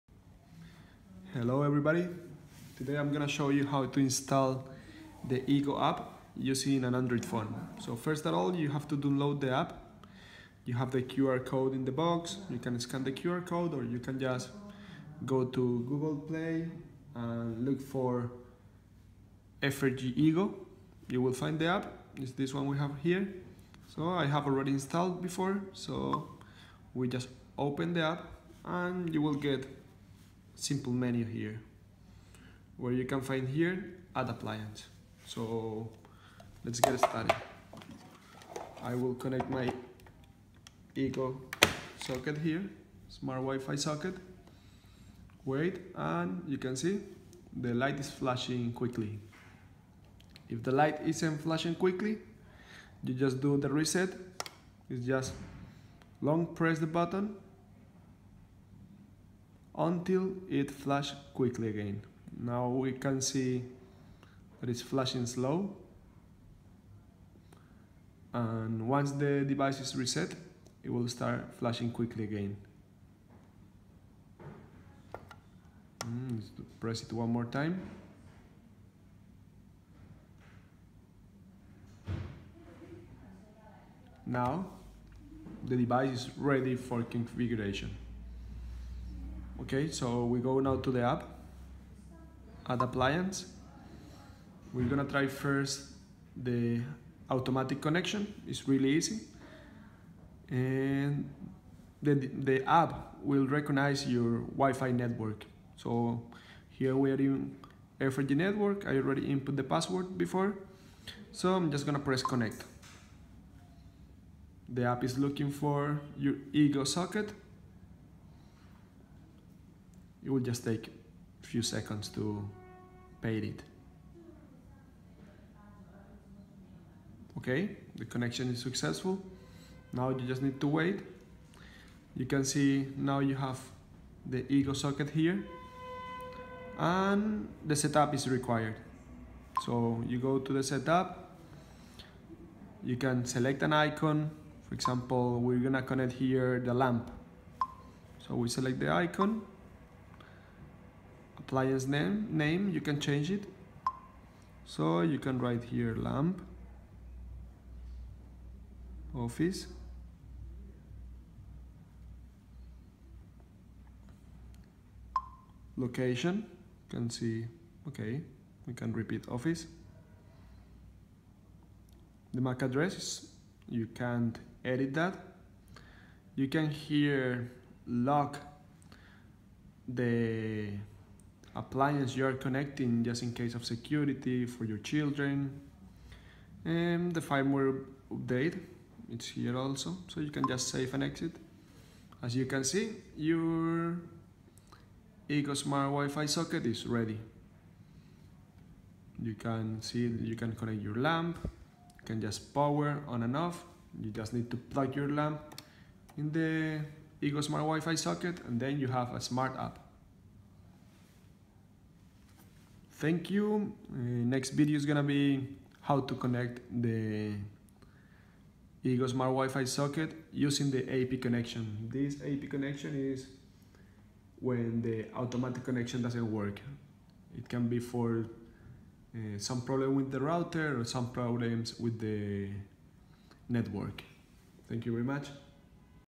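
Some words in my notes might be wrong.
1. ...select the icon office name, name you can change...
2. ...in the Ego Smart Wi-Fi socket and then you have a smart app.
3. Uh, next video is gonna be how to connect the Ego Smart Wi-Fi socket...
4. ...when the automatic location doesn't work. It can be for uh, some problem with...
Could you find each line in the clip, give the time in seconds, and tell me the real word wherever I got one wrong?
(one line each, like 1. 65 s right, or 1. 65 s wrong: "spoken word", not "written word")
1. 148 s wrong: "appliance", not "office"
2. 206 s right
3. 213 s right
4. 224 s wrong: "connection", not "location".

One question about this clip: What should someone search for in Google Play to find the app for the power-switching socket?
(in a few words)
efergy Ego.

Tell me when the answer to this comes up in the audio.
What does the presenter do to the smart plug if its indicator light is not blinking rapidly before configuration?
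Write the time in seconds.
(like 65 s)
56 s.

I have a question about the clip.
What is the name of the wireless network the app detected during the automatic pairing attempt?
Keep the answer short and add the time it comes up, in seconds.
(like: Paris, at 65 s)
Air4G, at 107 s.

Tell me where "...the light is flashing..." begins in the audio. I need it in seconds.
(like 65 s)
47 s.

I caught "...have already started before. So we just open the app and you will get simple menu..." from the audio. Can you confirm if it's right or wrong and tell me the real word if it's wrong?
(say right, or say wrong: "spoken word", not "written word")
wrong: "installed", not "started".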